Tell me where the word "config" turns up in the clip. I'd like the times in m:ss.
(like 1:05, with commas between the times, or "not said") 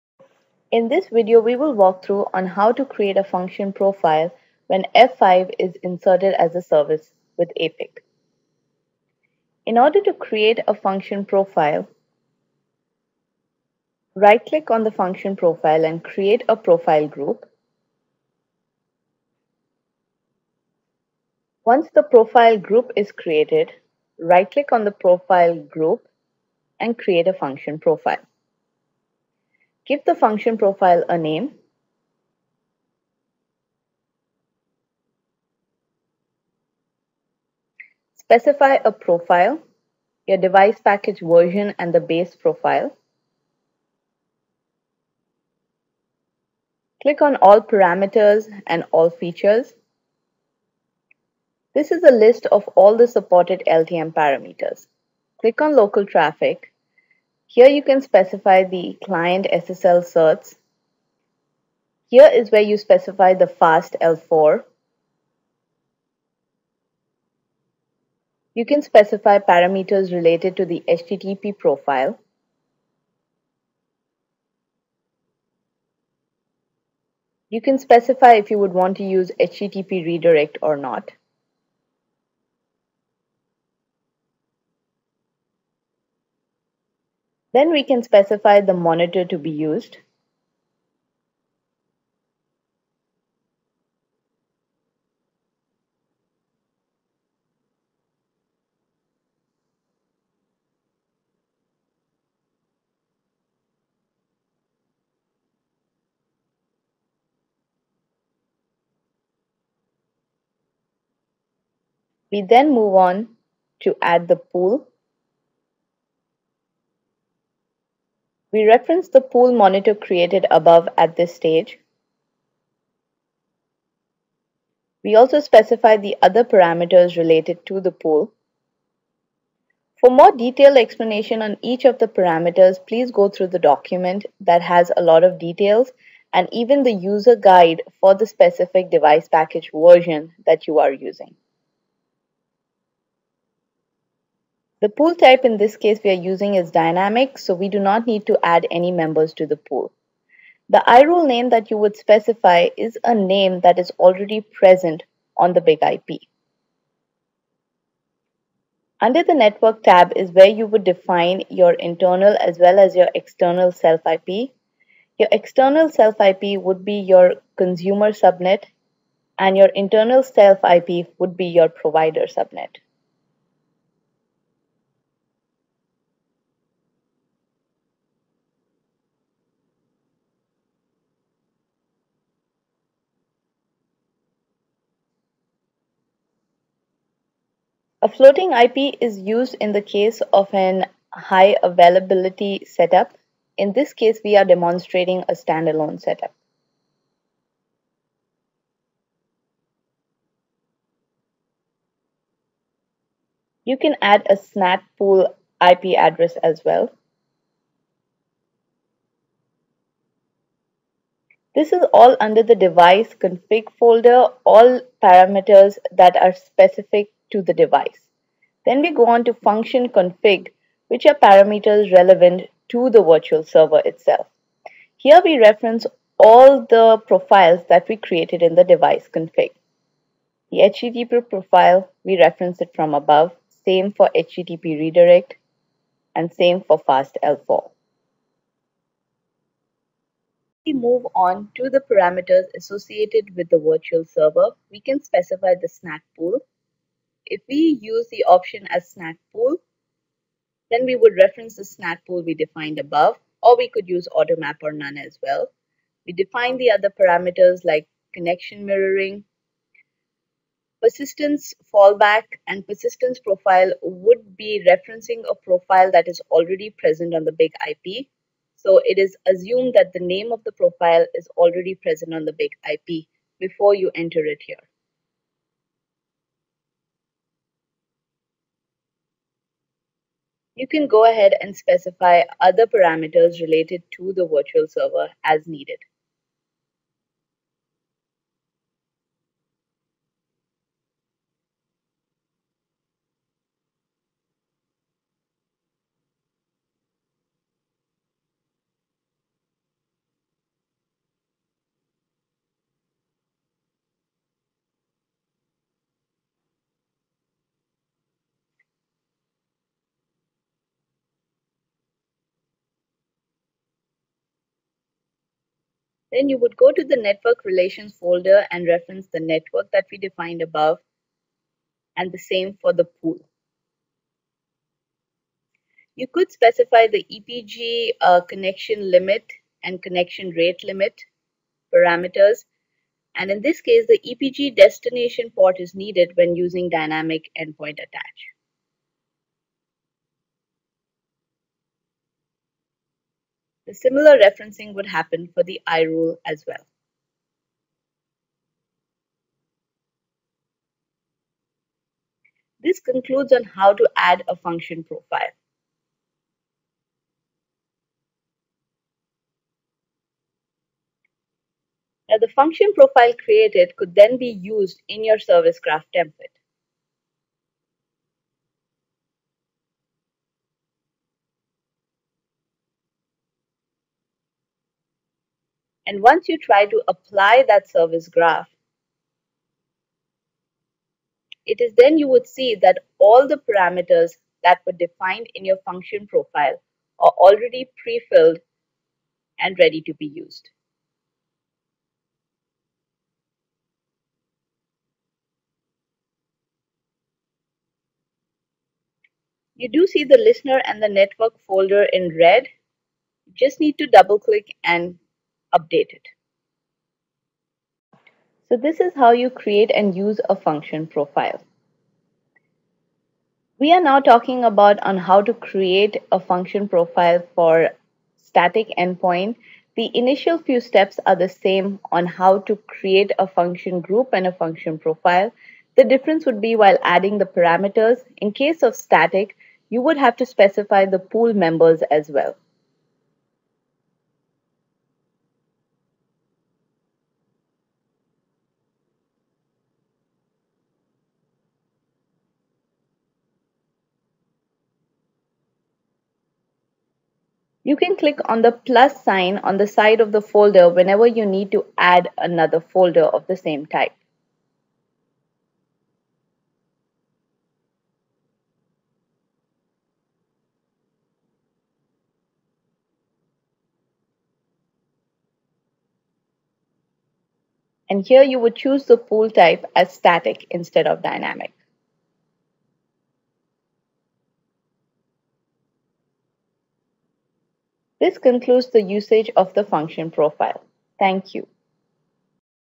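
3:33, 3:39, 3:49.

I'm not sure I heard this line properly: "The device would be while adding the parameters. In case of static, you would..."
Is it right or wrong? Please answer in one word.
wrong.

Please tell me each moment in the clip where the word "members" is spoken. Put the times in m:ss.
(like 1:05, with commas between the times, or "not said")
2:28, 7:11.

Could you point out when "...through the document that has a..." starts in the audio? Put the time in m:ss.
2:13.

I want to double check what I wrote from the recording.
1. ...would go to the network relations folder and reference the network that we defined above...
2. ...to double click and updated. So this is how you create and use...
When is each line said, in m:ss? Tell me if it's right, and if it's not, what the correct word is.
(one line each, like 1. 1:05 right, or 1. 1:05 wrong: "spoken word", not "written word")
1. 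5:16 right
2. 6:43 right.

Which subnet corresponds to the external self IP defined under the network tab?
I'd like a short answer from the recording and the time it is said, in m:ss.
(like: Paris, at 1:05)
Consumer subnet, at 2:47.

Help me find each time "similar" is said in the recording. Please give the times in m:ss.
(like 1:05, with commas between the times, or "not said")
5:43.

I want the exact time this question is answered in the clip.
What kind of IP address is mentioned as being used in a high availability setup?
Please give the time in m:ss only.
3:08.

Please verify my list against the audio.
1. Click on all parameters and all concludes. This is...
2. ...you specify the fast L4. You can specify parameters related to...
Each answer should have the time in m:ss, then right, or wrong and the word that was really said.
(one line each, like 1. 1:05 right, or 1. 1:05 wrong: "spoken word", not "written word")
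1. 0:47 wrong: "features", not "concludes"
2. 1:02 right.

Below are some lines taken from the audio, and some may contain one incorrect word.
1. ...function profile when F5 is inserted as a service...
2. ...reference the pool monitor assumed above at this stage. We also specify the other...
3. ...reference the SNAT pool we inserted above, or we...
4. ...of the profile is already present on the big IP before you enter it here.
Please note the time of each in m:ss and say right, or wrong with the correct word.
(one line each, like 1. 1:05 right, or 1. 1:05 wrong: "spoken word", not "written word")
1. 0:03 right
2. 1:58 wrong: "created", not "assumed"
3. 4:11 wrong: "defined", not "inserted"
4. 4:30 right.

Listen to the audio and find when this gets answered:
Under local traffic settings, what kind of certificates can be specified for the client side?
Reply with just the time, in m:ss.
0:59.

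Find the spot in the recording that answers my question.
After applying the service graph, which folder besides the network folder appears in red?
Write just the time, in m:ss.
6:40.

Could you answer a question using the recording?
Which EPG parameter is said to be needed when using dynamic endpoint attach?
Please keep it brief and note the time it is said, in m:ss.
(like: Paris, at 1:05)
EPG destination port, at 5:33.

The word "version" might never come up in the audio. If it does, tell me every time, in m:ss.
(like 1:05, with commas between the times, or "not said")
0:41, 2:19.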